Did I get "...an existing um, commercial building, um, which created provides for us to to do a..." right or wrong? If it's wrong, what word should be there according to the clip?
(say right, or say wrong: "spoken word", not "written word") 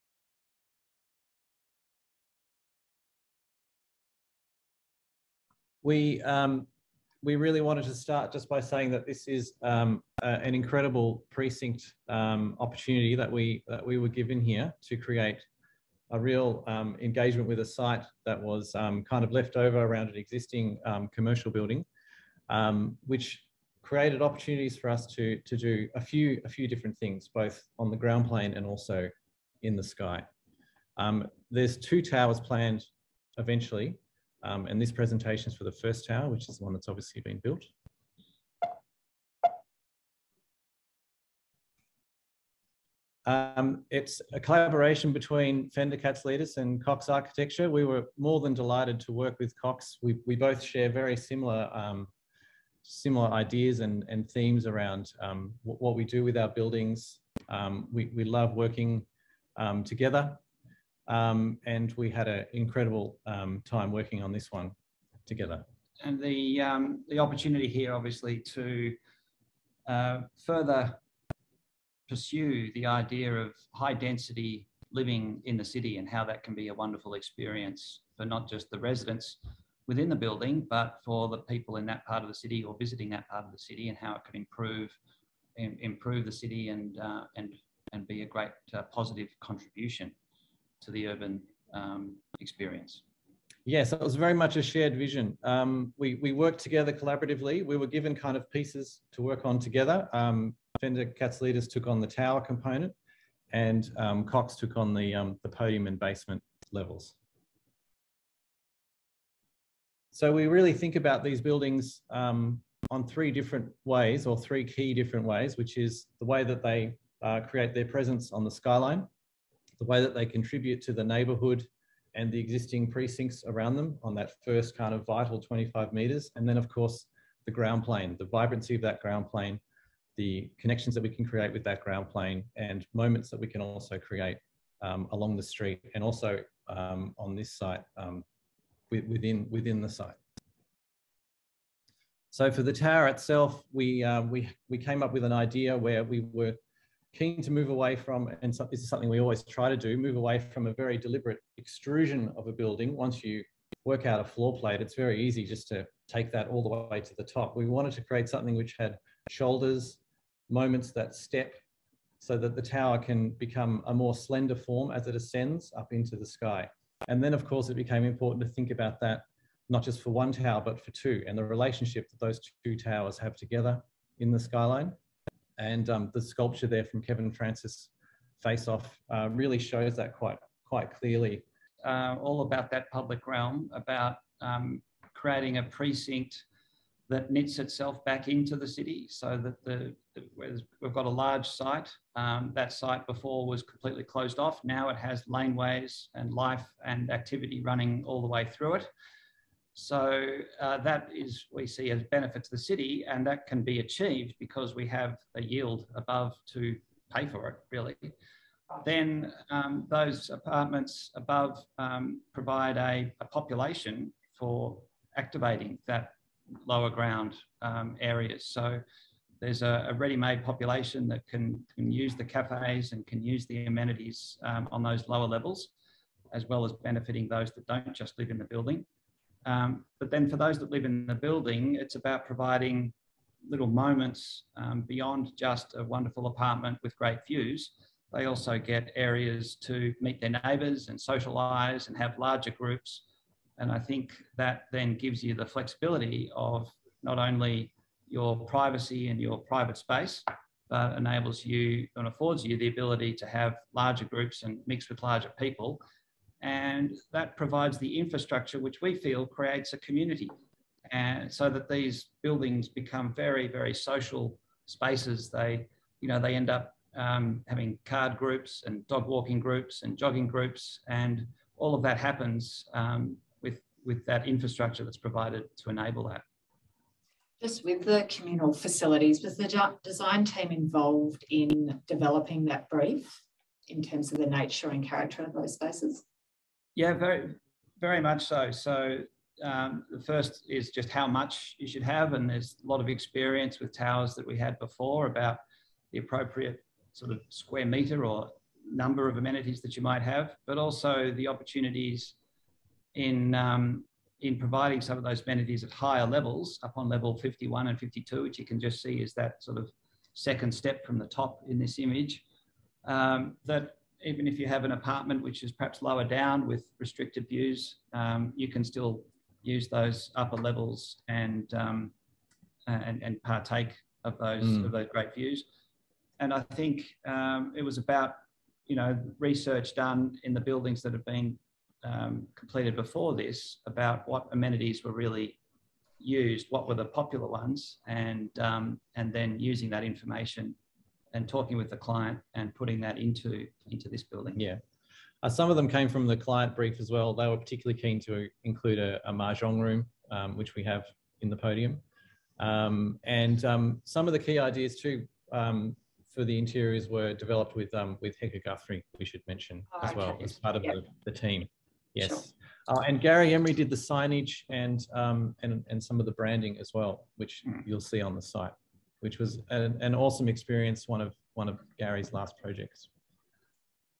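wrong: "opportunities", not "provides".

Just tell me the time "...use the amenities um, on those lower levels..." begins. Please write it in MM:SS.
03:43.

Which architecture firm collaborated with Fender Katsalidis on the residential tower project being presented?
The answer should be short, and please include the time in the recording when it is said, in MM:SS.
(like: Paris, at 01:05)
Cox Architecture, at 00:46.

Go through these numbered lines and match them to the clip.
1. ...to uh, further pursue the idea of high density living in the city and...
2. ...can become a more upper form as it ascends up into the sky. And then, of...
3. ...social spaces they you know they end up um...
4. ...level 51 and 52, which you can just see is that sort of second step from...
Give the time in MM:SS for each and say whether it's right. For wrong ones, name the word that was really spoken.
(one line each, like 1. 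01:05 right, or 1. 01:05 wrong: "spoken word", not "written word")
1. 01:08 right
2. 02:42 wrong: "slender", not "upper"
3. 04:23 right
4. 05:06 right.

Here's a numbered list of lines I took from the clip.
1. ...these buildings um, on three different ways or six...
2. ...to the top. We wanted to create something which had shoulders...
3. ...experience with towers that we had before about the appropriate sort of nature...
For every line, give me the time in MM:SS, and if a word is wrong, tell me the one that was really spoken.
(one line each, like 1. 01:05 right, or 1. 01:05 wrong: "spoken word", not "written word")
1. 01:51 wrong: "three", not "six"
2. 02:37 right
3. 04:52 wrong: "square", not "nature".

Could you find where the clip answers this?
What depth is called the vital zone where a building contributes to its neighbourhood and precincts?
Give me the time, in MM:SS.
02:05.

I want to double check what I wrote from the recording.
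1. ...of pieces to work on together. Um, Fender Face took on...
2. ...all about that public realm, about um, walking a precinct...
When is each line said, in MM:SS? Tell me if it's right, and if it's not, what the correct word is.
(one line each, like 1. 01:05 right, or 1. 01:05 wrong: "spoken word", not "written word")
1. 01:38 wrong: "Katsalidis", not "Face"
2. 03:02 wrong: "creating", not "walking".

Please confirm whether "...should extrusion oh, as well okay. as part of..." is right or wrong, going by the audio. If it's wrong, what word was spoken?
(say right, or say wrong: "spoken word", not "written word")
wrong: "mention", not "extrusion".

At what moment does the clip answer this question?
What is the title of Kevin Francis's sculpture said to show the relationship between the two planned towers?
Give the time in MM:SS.
02:58.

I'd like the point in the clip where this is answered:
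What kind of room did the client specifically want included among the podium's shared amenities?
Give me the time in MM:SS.
05:49.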